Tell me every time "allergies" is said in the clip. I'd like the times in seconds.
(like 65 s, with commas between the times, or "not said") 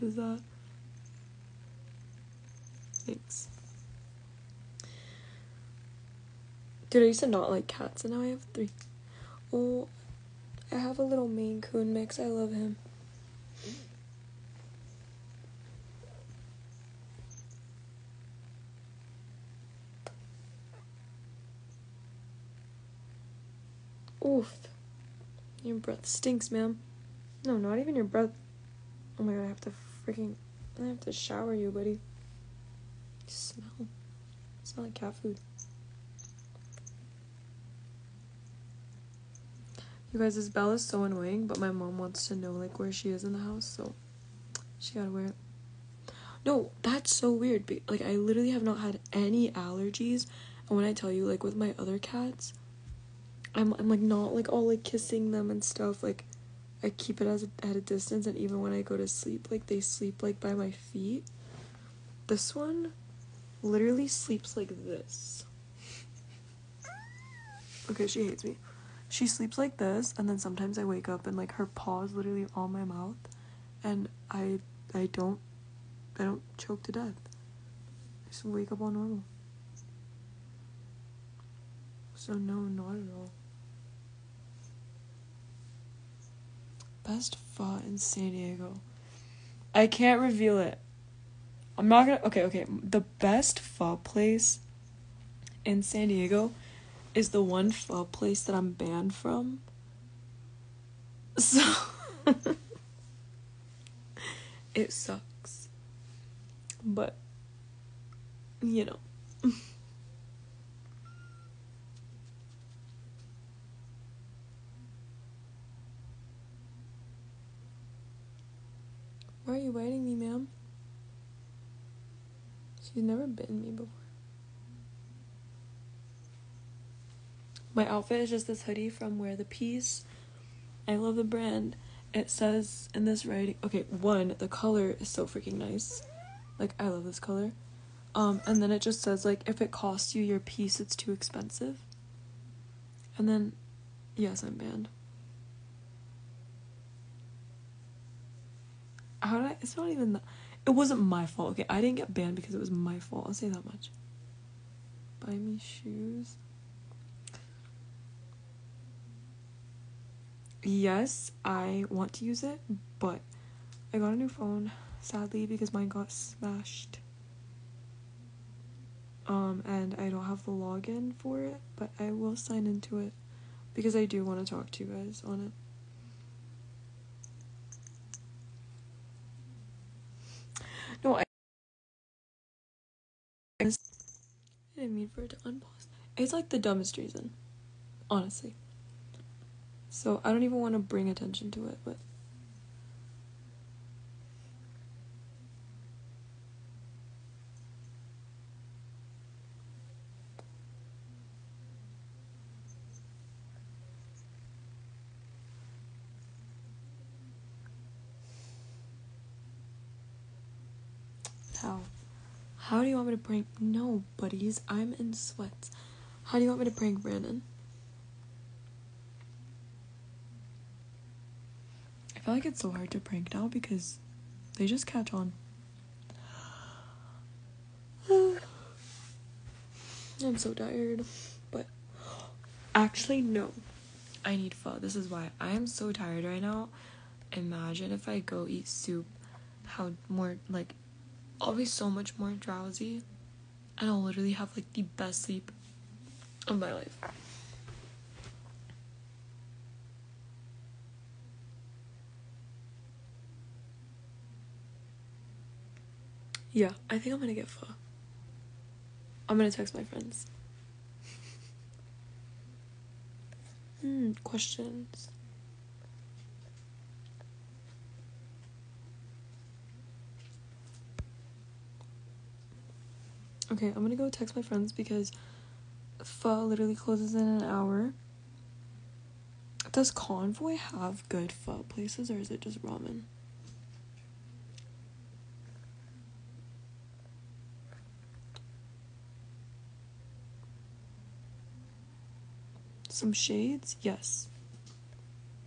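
49 s.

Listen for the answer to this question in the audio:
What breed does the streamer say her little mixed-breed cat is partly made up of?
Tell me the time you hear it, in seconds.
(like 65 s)
11 s.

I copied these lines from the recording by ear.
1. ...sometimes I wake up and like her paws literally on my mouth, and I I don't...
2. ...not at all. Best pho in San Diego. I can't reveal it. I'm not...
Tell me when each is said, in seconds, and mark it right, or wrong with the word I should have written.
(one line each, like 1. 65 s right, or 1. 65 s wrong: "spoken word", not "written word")
1. 70 s right
2. 82 s right.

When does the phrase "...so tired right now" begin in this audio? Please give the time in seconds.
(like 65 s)
235 s.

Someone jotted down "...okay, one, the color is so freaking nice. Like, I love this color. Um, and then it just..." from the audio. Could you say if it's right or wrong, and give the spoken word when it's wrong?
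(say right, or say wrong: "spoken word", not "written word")
right.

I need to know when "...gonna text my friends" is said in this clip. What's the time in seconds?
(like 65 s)
259 s.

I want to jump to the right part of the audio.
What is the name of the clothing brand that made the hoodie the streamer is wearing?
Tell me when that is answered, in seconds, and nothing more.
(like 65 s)
129 s.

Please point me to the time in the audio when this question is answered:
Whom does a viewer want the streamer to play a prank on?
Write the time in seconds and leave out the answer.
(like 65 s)
217 s.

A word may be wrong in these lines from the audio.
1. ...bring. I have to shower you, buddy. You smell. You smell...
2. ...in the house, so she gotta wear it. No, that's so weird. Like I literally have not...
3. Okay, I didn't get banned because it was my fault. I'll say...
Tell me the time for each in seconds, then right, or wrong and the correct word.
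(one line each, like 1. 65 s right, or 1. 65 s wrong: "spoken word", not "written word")
1. 30 s wrong: "freaking", not "bring"
2. 43 s right
3. 151 s right.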